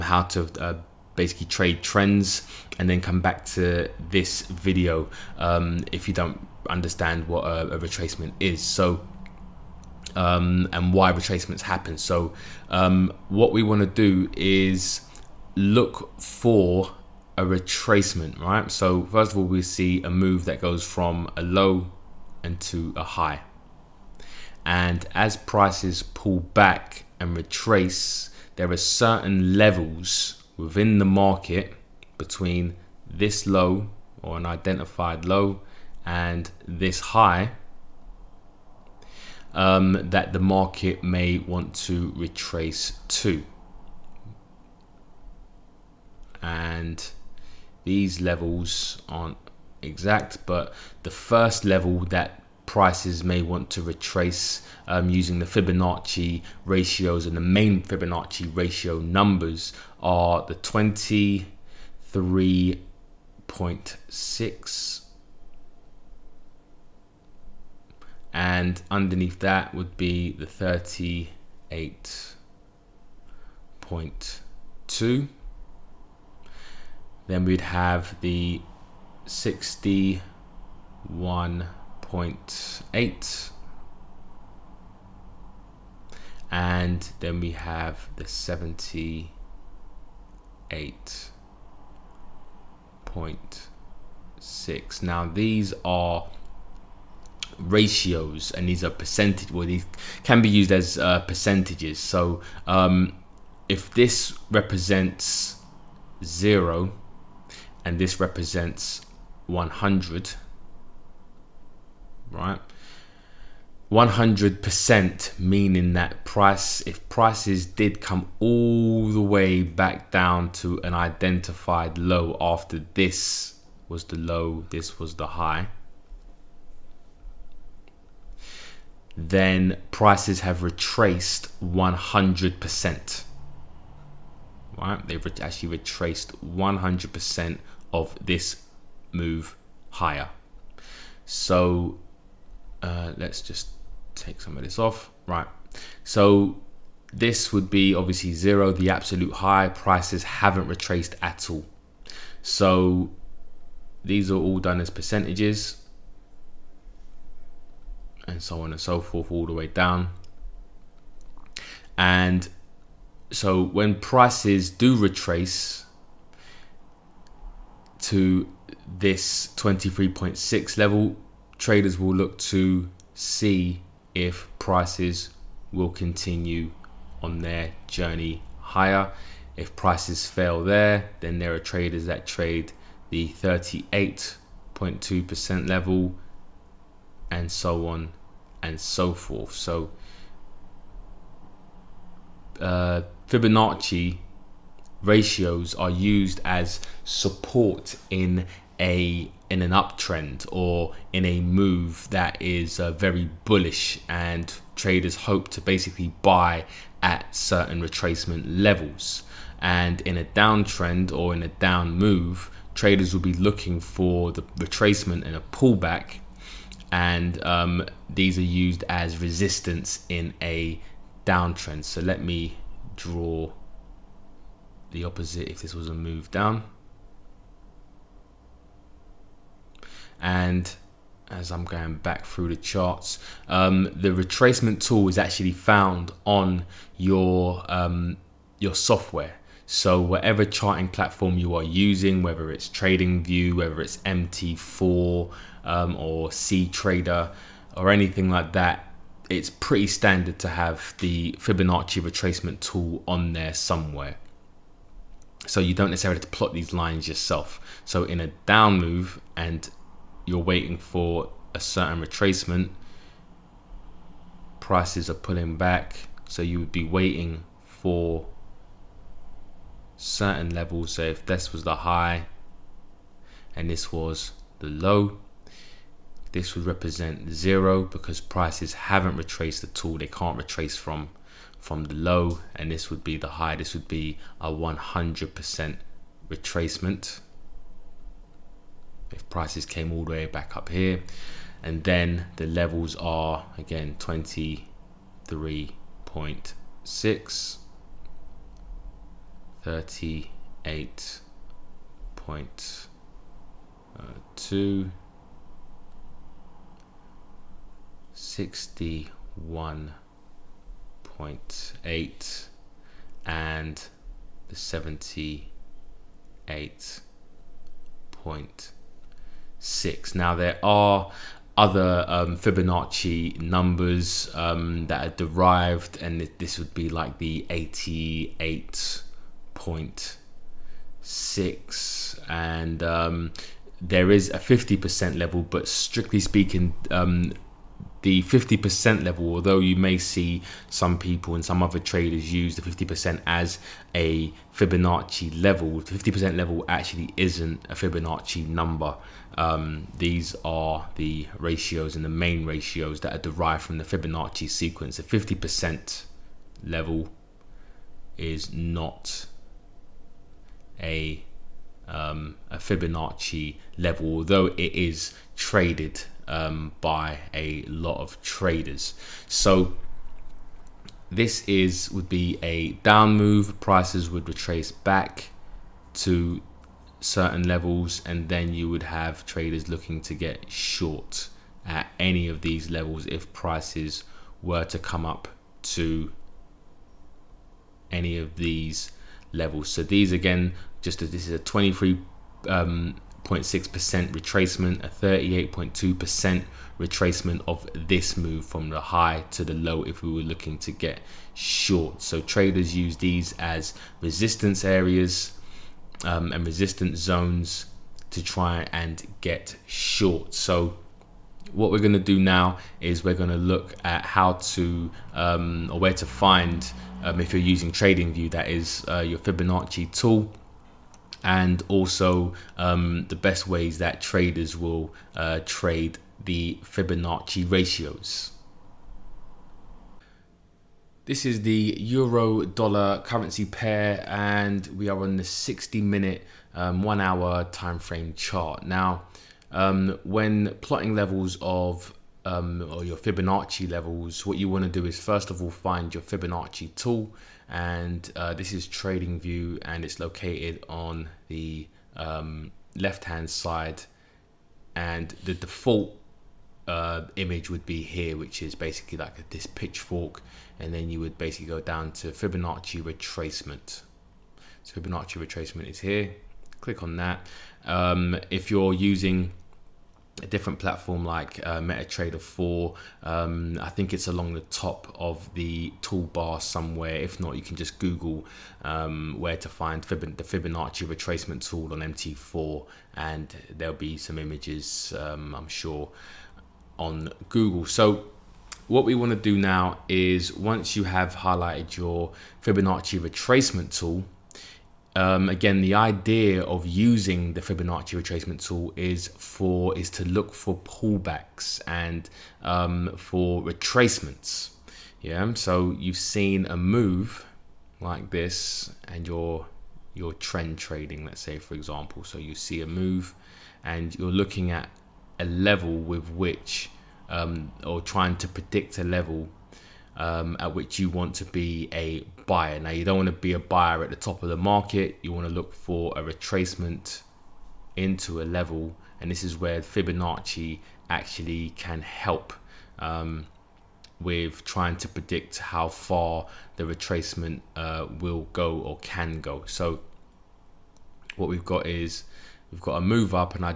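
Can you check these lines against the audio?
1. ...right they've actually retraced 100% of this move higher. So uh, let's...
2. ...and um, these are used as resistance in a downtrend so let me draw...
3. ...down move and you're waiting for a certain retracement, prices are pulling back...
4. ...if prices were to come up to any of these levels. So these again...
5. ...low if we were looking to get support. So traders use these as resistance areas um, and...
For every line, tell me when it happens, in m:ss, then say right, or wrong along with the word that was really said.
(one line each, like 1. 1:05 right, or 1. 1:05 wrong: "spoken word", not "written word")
1. 2:14 right
2. 3:36 right
3. 4:18 right
4. 6:23 right
5. 6:39 wrong: "short", not "support".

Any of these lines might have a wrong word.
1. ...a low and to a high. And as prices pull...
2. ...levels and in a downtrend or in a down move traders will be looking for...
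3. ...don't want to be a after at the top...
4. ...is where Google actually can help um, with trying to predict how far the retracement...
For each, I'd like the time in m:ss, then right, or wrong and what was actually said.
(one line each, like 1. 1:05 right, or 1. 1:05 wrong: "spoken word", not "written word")
1. 0:21 right
2. 3:28 right
3. 8:42 wrong: "buyer", not "after"
4. 8:49 wrong: "Fibonacci", not "Google".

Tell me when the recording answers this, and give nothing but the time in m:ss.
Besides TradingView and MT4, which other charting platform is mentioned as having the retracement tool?
4:06.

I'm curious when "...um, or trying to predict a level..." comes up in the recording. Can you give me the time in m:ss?
8:37.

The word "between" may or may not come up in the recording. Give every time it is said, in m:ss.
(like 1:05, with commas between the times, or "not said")
0:32.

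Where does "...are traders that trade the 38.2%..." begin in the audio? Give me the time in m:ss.
3:01.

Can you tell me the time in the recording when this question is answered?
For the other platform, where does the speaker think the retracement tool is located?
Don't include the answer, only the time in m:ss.
7:54.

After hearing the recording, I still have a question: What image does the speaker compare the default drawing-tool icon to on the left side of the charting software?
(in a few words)
pitchfork.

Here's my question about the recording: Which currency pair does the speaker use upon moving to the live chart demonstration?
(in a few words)
euro dollar.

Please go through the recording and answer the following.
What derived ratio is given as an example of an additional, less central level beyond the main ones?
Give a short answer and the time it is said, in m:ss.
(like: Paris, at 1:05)
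88.6, at 5:27.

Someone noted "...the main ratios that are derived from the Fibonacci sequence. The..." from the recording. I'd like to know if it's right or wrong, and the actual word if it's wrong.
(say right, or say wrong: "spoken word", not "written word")
right.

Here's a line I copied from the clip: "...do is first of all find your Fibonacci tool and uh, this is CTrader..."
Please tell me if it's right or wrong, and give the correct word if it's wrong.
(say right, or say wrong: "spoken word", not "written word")
wrong: "TradingView", not "CTrader".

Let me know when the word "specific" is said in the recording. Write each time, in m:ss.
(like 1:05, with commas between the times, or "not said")
not said.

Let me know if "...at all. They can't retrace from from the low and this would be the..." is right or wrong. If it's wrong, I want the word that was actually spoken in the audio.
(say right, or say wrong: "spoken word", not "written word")
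right.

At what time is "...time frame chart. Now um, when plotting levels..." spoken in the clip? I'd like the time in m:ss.
7:17.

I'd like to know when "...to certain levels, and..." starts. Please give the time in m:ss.
6:15.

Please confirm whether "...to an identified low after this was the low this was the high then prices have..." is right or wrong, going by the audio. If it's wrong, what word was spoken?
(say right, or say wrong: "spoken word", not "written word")
right.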